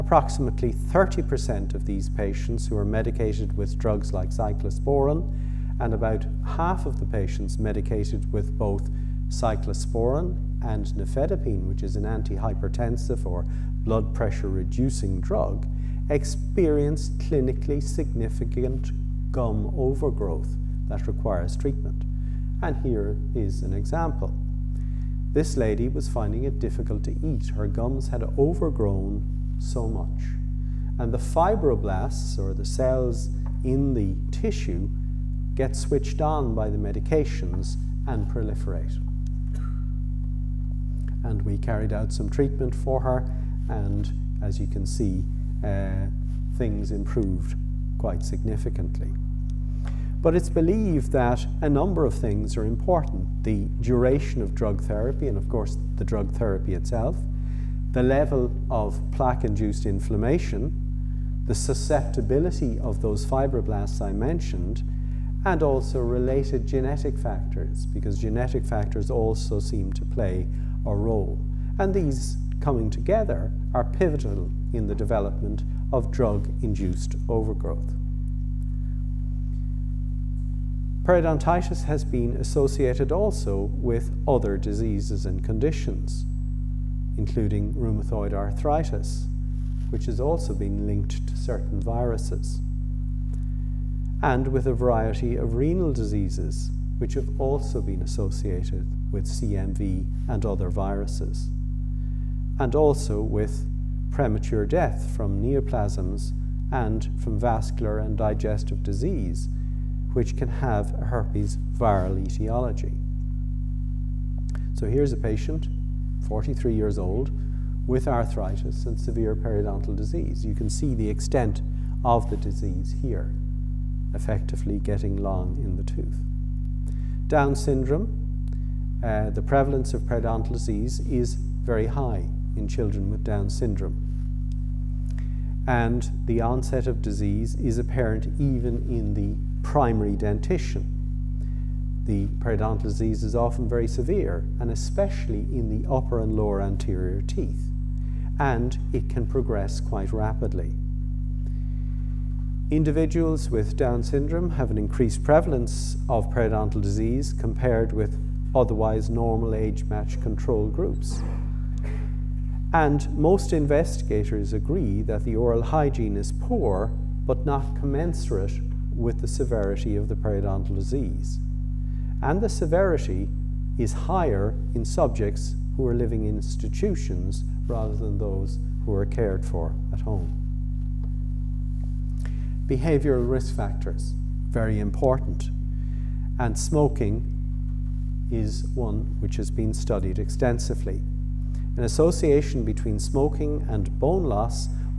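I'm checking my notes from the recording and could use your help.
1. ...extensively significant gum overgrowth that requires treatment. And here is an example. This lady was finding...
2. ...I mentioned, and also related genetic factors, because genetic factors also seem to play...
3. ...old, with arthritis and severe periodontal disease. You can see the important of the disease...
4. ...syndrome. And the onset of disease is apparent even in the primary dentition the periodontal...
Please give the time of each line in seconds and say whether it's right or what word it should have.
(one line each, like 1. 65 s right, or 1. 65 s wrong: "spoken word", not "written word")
1. 17 s wrong: "clinically", not "extensively"
2. 64 s right
3. 116 s wrong: "extent", not "important"
4. 133 s right.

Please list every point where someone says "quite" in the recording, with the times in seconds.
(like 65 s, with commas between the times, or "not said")
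47 s, 149 s.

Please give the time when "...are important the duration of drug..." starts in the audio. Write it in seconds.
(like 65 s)
52 s.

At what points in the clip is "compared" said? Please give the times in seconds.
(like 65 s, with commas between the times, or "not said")
157 s.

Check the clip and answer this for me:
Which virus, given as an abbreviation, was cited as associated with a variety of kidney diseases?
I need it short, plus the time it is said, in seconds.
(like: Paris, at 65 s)
CMV, at 99 s.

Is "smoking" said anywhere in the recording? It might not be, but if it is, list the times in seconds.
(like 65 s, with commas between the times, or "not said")
186 s, 192 s.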